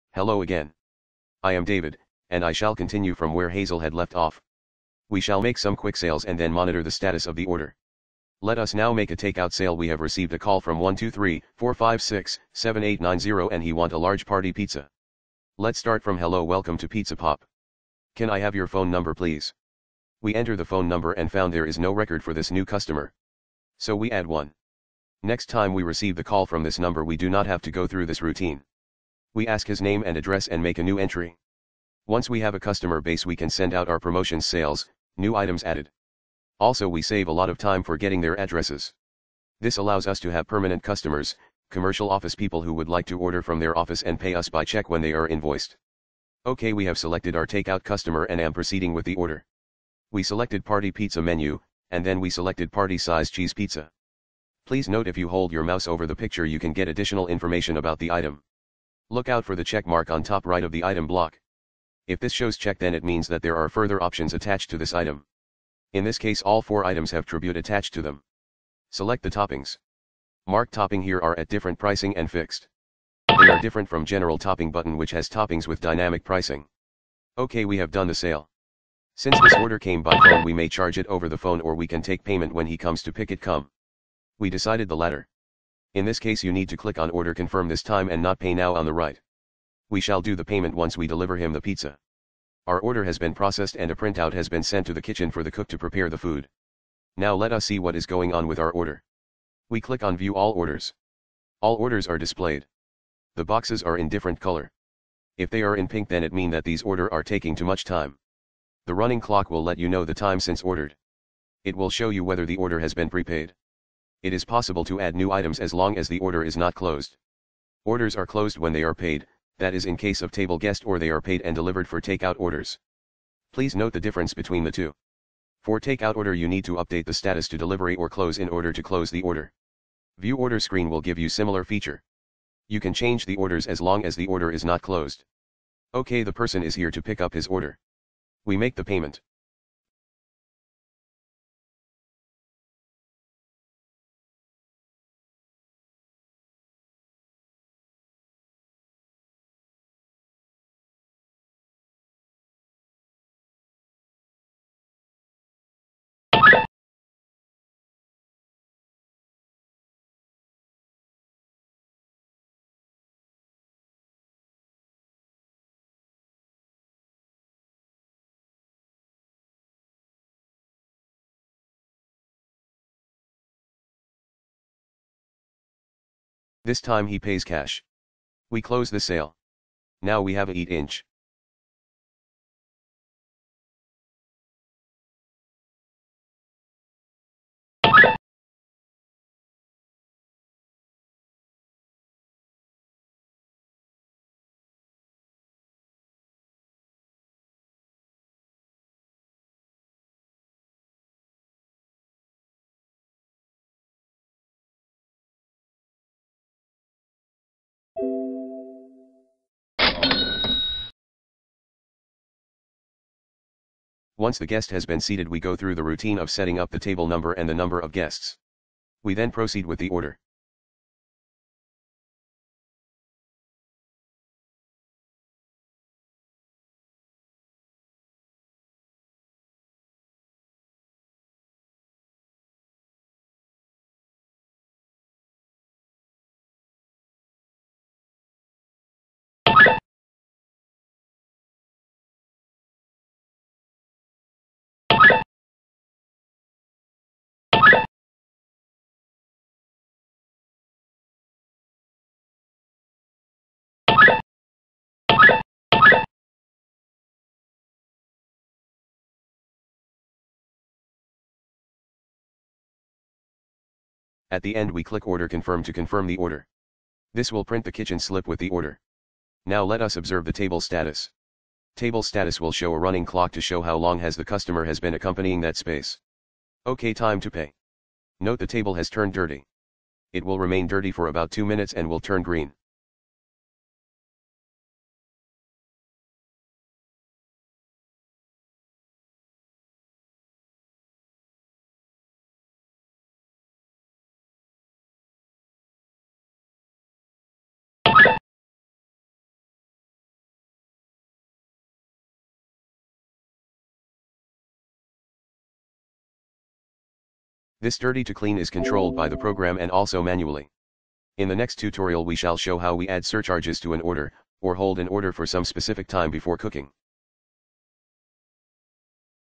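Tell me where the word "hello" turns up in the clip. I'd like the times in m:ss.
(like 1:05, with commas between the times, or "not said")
0:00, 0:16.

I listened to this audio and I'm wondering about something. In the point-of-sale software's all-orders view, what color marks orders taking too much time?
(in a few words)
pink.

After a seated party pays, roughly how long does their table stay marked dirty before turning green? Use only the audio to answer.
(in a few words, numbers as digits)
2 minutes.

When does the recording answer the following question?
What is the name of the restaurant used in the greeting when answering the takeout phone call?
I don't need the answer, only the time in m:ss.
0:16.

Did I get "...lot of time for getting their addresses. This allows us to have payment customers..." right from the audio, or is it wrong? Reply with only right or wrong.
wrong.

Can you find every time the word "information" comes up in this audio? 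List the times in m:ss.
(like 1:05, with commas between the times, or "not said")
0:57.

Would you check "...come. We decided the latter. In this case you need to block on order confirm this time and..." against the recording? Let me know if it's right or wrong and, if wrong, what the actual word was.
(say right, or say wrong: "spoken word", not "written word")
wrong: "click", not "block".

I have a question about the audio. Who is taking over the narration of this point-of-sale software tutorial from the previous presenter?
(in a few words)
David.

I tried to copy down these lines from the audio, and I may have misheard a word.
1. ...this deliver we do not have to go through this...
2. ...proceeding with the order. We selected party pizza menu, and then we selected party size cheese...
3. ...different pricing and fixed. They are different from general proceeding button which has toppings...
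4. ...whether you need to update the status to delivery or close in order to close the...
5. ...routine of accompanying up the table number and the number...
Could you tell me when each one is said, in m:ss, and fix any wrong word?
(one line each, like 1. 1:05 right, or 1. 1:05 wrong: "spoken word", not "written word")
1. 0:26 wrong: "number", not "deliver"
2. 0:48 right
3. 1:11 wrong: "topping", not "proceeding"
4. 2:06 wrong: "order", not "whether"
5. 3:35 wrong: "setting", not "accompanying".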